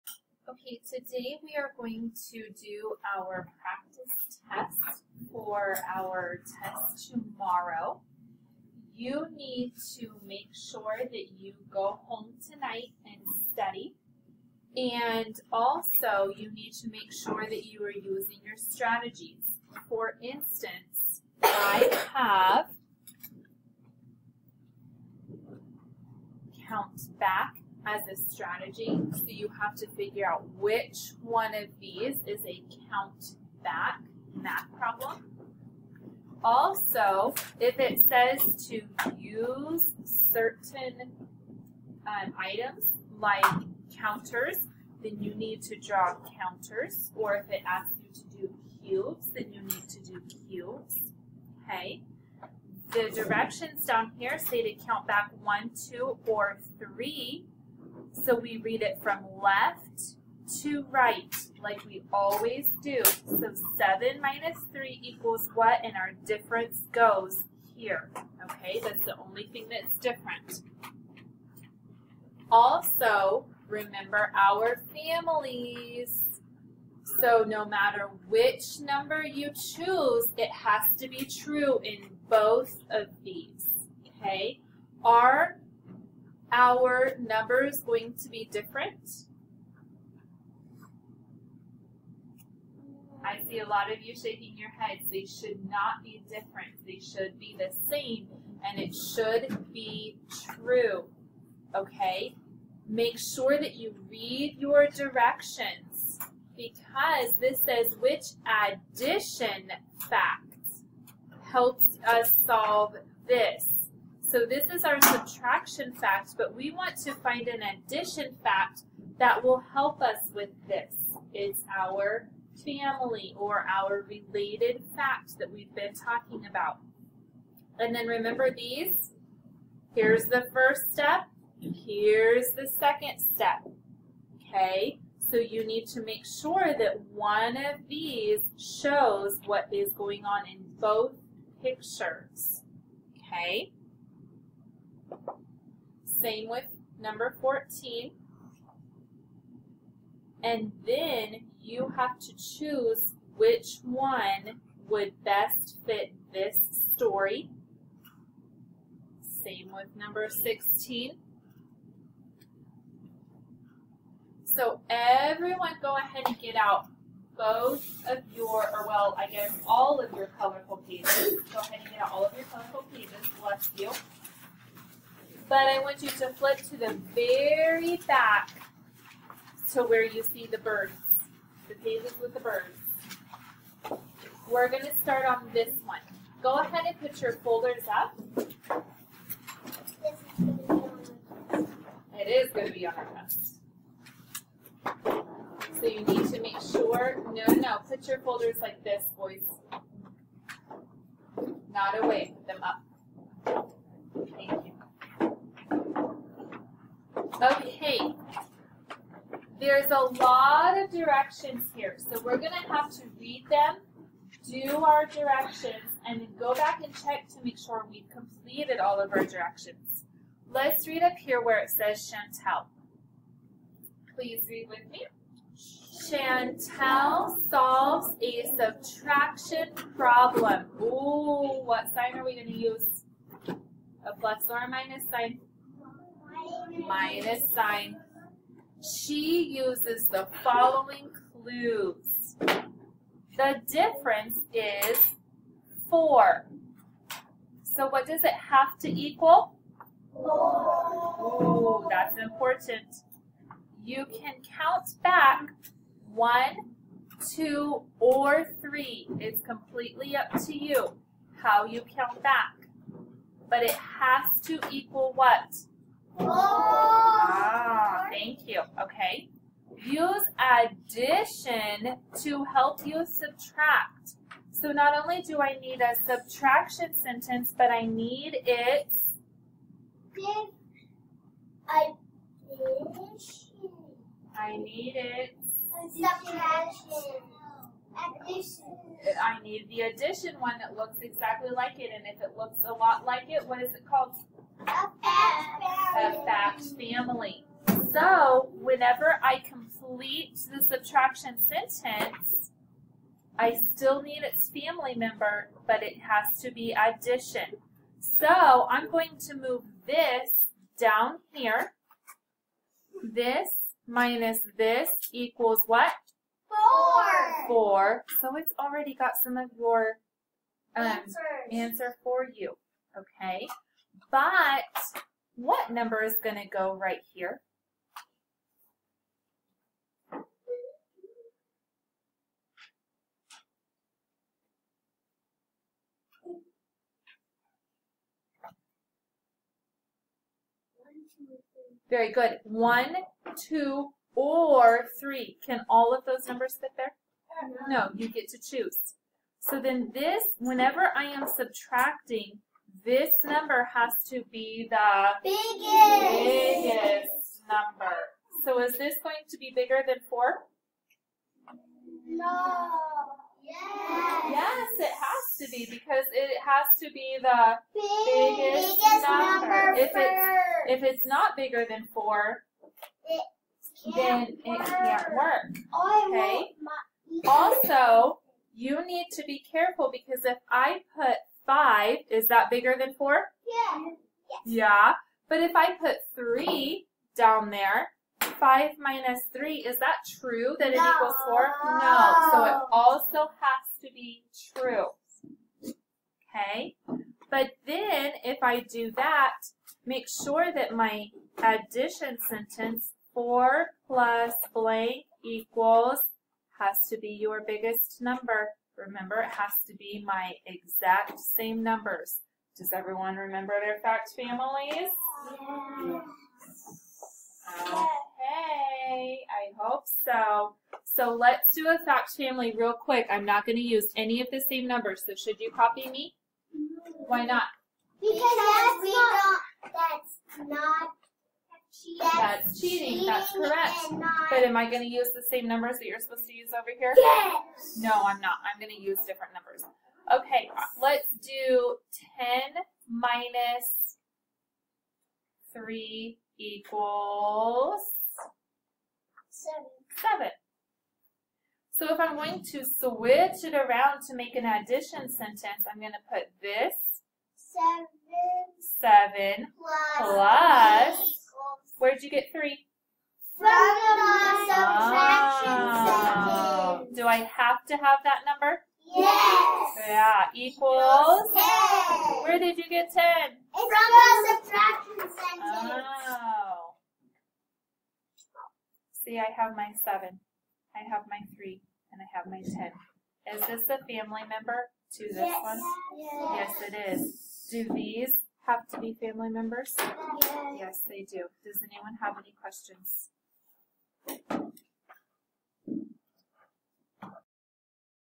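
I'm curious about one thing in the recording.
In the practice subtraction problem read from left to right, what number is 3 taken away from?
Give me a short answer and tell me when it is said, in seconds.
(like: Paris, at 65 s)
7, at 63 s.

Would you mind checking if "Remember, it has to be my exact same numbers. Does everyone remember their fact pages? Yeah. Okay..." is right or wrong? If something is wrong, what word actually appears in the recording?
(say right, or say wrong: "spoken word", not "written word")
wrong: "families", not "pages".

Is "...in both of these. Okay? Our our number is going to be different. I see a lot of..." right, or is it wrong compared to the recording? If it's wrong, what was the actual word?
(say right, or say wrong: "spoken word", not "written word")
right.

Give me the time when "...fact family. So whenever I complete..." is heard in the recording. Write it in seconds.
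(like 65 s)
296 s.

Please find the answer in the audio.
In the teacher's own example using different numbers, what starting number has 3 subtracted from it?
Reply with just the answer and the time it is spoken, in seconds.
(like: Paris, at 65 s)
10, at 442 s.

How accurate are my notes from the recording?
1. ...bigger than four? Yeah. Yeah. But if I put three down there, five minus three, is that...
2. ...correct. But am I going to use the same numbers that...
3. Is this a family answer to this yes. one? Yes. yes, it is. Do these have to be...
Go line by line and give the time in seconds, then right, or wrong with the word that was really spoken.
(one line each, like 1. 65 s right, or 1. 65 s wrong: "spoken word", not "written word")
1. 382 s right
2. 433 s right
3. 483 s wrong: "member", not "answer".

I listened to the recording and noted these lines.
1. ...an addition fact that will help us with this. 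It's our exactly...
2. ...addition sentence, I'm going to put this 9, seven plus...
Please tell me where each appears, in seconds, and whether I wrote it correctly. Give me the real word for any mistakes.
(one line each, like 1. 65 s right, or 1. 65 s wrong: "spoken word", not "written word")
1. 117 s wrong: "family", not "exactly"
2. 454 s wrong: "7", not "9".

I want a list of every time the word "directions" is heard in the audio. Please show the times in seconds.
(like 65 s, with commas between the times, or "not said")
53 s, 104 s, 210 s, 215 s, 219 s.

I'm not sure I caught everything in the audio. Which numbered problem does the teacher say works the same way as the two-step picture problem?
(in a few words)
14.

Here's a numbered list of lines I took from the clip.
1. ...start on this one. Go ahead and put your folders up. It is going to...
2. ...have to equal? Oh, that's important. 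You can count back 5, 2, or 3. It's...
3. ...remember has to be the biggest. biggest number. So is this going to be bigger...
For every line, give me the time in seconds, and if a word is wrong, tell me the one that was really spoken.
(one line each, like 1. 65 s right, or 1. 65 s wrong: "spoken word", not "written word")
1. 185 s right
2. 248 s wrong: "1", not "5"
3. 353 s wrong: "number", not "remember".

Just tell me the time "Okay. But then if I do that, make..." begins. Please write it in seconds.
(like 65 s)
396 s.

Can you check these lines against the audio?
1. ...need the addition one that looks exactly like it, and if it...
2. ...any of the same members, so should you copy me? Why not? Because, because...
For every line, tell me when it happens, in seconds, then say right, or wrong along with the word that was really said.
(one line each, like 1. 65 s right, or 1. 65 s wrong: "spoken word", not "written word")
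1. 289 s right
2. 423 s wrong: "numbers", not "members".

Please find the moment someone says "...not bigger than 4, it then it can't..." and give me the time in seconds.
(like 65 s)
371 s.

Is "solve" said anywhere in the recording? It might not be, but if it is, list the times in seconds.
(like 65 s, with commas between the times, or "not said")
112 s, 227 s.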